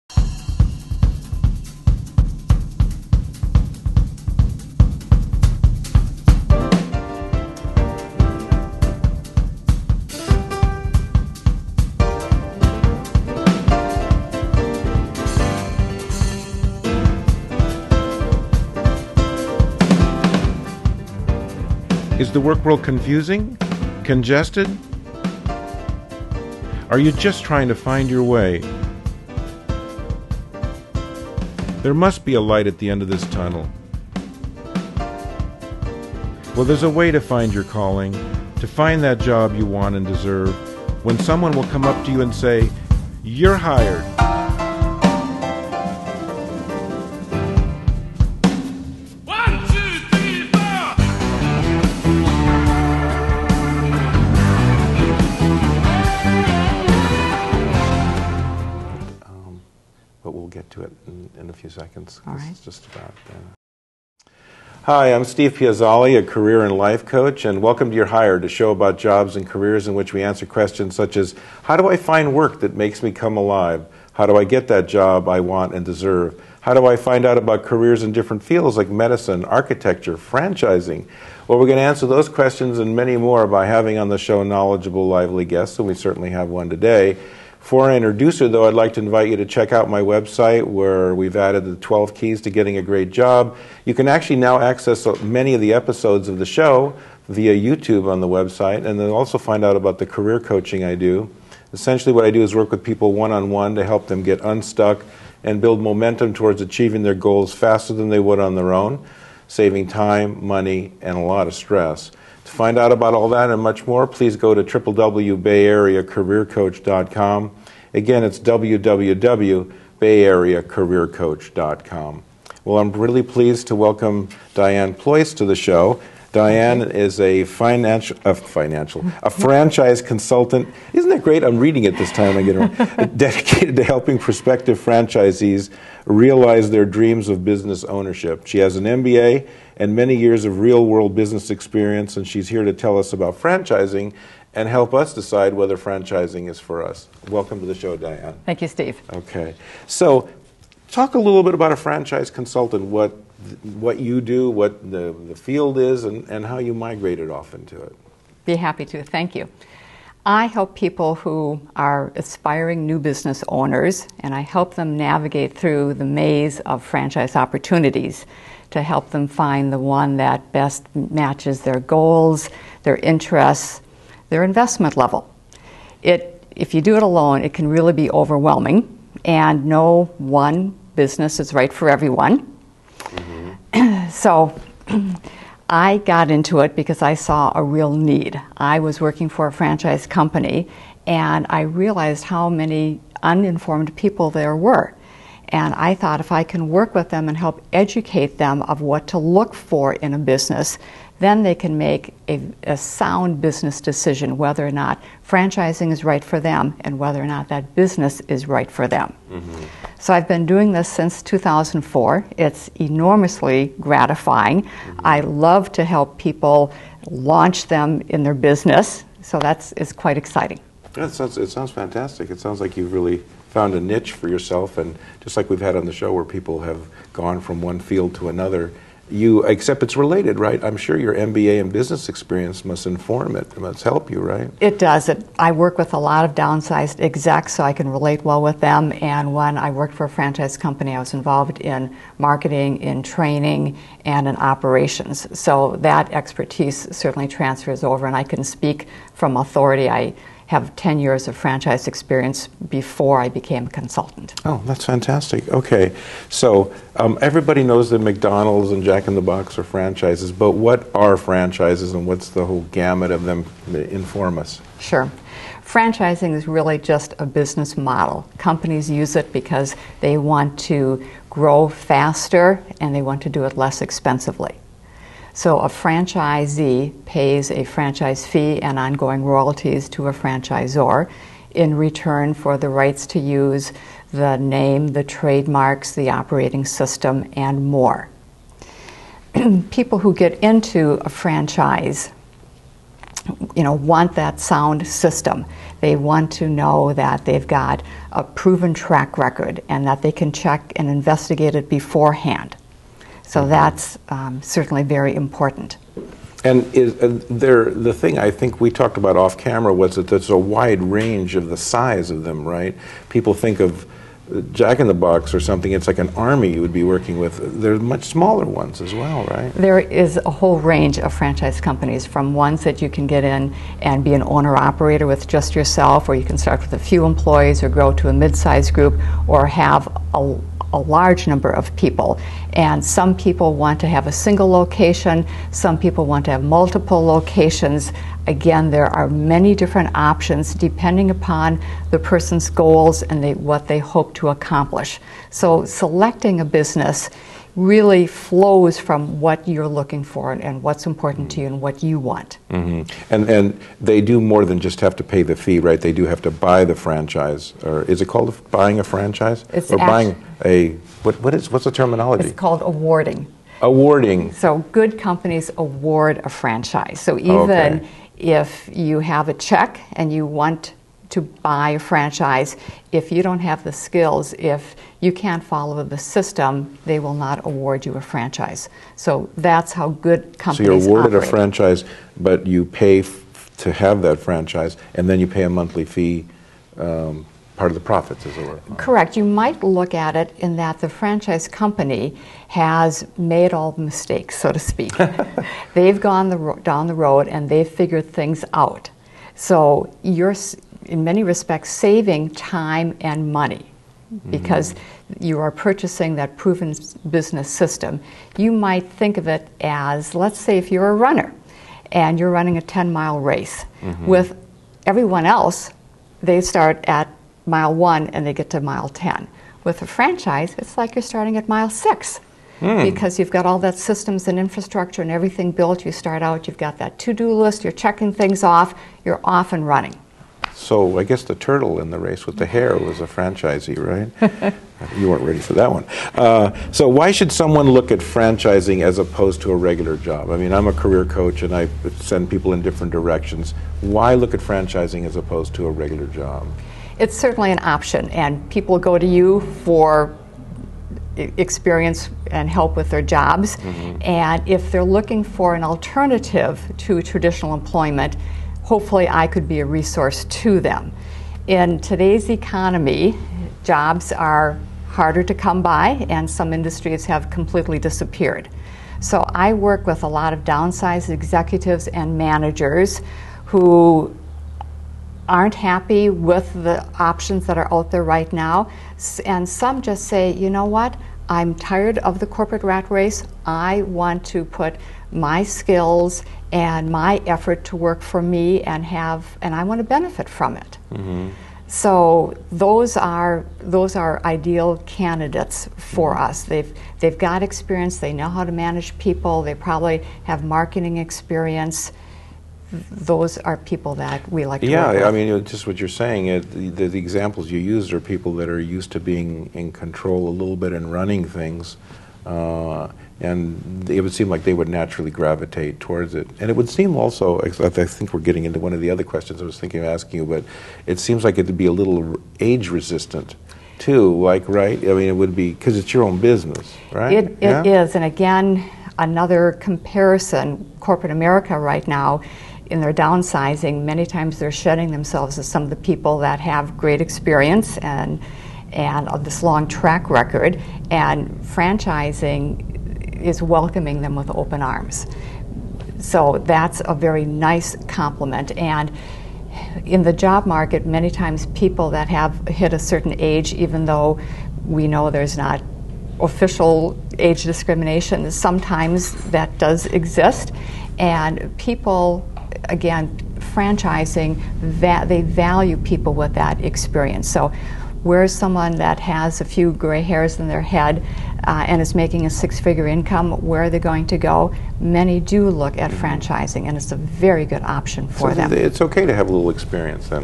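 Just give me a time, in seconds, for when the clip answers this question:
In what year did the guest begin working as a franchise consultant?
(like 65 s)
211 s.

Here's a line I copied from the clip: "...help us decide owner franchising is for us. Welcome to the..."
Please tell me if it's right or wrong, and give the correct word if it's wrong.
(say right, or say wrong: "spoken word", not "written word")
wrong: "whether", not "owner".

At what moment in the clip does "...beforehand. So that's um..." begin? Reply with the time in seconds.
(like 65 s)
301 s.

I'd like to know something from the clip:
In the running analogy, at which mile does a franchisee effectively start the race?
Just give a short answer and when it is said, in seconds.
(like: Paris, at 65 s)
Mile 6, at 421 s.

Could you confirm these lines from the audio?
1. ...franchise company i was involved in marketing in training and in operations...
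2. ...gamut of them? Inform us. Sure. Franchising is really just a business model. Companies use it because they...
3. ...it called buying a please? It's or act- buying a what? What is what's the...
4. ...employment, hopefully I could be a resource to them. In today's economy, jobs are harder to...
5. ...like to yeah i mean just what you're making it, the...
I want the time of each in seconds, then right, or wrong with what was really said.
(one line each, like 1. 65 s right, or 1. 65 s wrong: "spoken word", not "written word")
1. 240 s right
2. 262 s right
3. 358 s wrong: "franchise", not "please"
4. 457 s right
5. 504 s wrong: "saying", not "making".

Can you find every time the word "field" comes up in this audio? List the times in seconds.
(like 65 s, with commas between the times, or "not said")
78 s, 155 s, 227 s.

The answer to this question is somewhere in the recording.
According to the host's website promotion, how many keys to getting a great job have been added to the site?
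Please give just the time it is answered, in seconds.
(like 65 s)
91 s.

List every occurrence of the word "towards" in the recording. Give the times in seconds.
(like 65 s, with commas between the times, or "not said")
106 s, 515 s.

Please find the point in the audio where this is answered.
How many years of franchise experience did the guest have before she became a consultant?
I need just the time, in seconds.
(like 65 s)
250 s.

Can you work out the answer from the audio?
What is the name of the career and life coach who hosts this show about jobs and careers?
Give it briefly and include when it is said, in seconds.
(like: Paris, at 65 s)
Steve Piazzale, at 65 s.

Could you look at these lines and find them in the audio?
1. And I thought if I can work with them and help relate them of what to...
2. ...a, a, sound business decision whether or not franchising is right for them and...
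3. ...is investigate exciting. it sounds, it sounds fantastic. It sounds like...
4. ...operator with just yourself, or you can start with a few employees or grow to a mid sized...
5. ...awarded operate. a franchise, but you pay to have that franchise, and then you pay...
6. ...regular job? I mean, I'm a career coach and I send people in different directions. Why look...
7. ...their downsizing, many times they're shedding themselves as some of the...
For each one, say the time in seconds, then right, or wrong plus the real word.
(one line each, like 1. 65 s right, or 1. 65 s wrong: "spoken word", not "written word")
1. 195 s wrong: "educate", not "relate"
2. 202 s right
3. 219 s wrong: "quite", not "investigate"
4. 324 s right
5. 380 s right
6. 439 s right
7. 532 s right.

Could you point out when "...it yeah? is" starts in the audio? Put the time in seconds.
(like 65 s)
527 s.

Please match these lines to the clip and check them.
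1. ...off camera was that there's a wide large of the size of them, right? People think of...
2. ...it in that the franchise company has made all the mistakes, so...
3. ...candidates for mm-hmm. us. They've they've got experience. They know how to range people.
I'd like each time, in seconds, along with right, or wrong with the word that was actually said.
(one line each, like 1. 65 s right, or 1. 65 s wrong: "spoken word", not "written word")
1. 309 s wrong: "range", not "large"
2. 390 s right
3. 494 s wrong: "manage", not "range".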